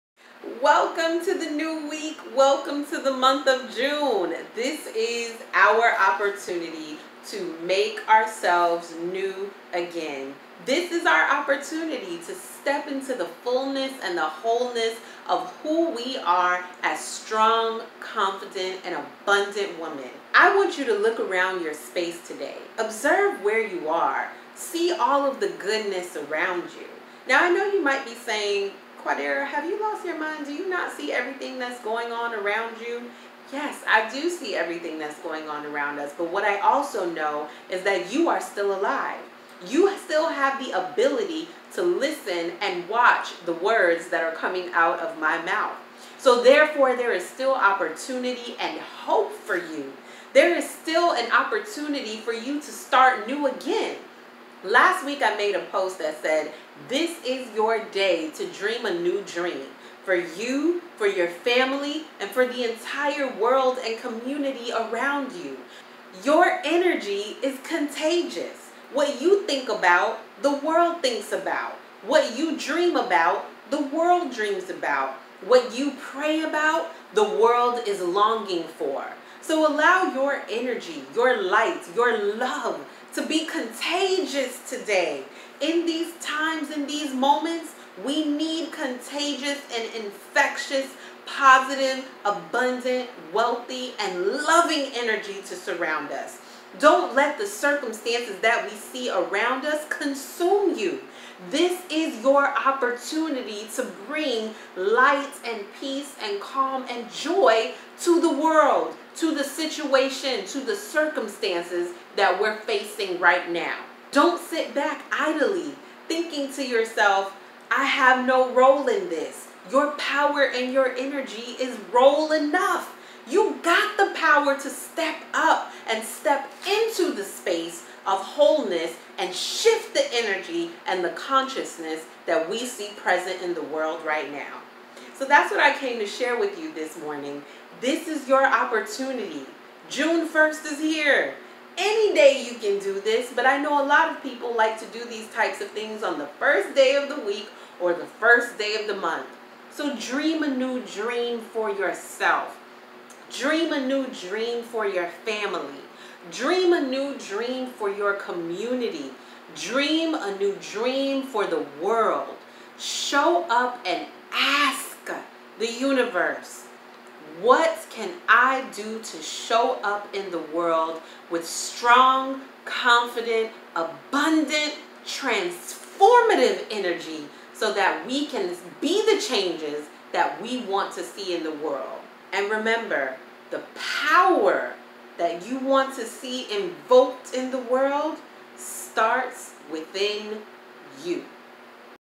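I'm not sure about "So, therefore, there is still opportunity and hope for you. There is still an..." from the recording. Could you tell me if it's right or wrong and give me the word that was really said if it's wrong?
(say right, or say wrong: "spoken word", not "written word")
right.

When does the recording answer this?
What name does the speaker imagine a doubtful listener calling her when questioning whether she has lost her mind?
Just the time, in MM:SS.
00:29.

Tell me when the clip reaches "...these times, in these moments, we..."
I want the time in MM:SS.
01:25.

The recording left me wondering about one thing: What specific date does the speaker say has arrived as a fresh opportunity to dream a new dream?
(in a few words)
June 1st.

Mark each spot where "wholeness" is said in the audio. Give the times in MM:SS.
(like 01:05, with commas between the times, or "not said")
00:14, 02:08.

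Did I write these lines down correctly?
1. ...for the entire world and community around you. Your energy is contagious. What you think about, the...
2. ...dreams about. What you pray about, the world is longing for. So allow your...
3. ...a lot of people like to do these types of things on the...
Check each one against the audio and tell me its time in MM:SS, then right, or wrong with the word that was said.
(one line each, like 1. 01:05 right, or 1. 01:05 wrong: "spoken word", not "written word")
1. 01:02 right
2. 01:14 right
3. 02:23 right.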